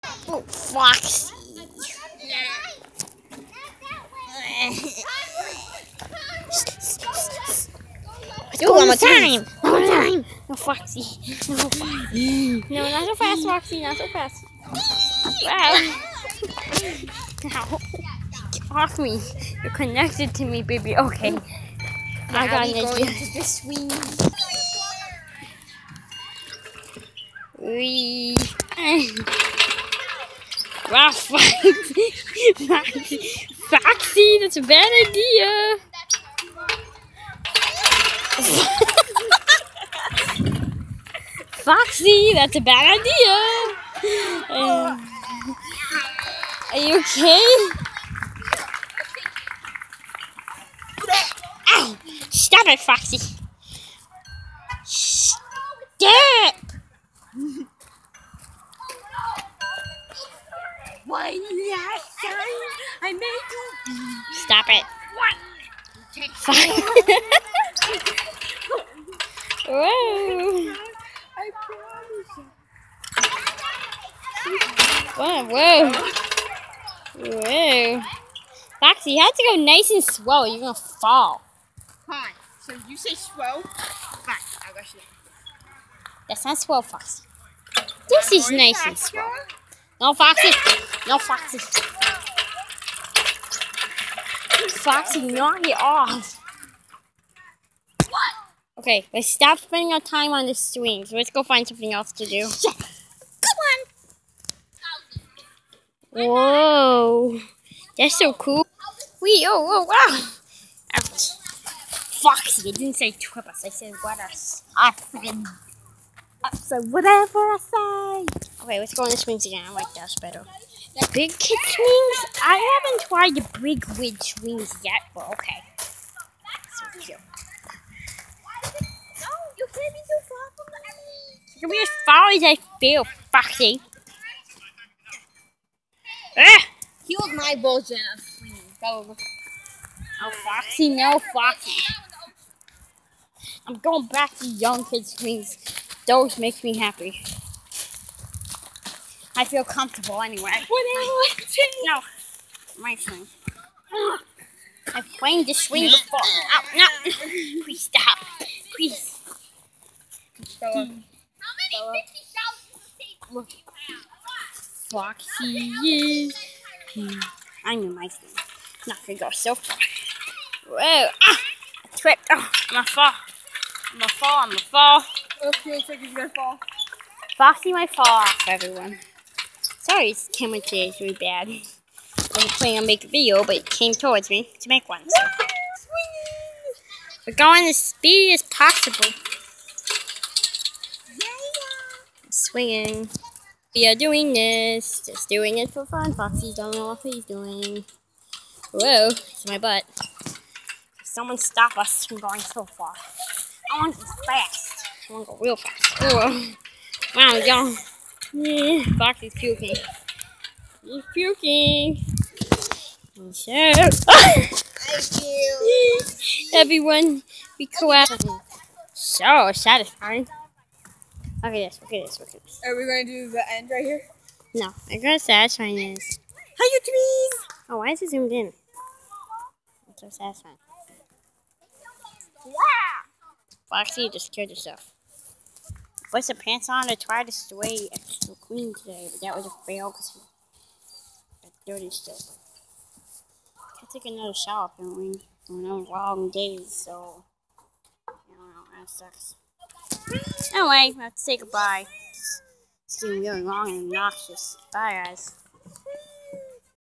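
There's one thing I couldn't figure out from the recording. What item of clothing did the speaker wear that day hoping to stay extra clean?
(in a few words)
pants.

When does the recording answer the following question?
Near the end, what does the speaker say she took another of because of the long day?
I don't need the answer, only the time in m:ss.
4:04.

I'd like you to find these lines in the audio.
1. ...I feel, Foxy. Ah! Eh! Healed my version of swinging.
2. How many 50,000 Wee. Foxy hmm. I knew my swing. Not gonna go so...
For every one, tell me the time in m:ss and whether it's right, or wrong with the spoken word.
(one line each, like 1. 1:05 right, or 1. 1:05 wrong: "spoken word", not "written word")
1. 2:12 right
2. 2:40 wrong: "Look", not "Wee".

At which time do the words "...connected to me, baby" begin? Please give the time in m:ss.
0:19.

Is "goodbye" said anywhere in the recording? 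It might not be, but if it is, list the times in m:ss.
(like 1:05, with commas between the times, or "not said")
4:11.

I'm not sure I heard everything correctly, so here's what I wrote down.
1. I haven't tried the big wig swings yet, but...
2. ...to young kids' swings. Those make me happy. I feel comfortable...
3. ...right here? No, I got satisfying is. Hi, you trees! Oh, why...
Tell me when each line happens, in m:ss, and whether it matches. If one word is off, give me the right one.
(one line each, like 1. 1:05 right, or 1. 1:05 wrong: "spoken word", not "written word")
1. 2:02 right
2. 2:24 right
3. 3:43 right.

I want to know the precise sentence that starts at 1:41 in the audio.
So let's go find something else to do.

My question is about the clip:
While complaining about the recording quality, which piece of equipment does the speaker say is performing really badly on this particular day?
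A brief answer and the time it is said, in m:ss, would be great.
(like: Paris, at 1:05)
camera, at 3:00.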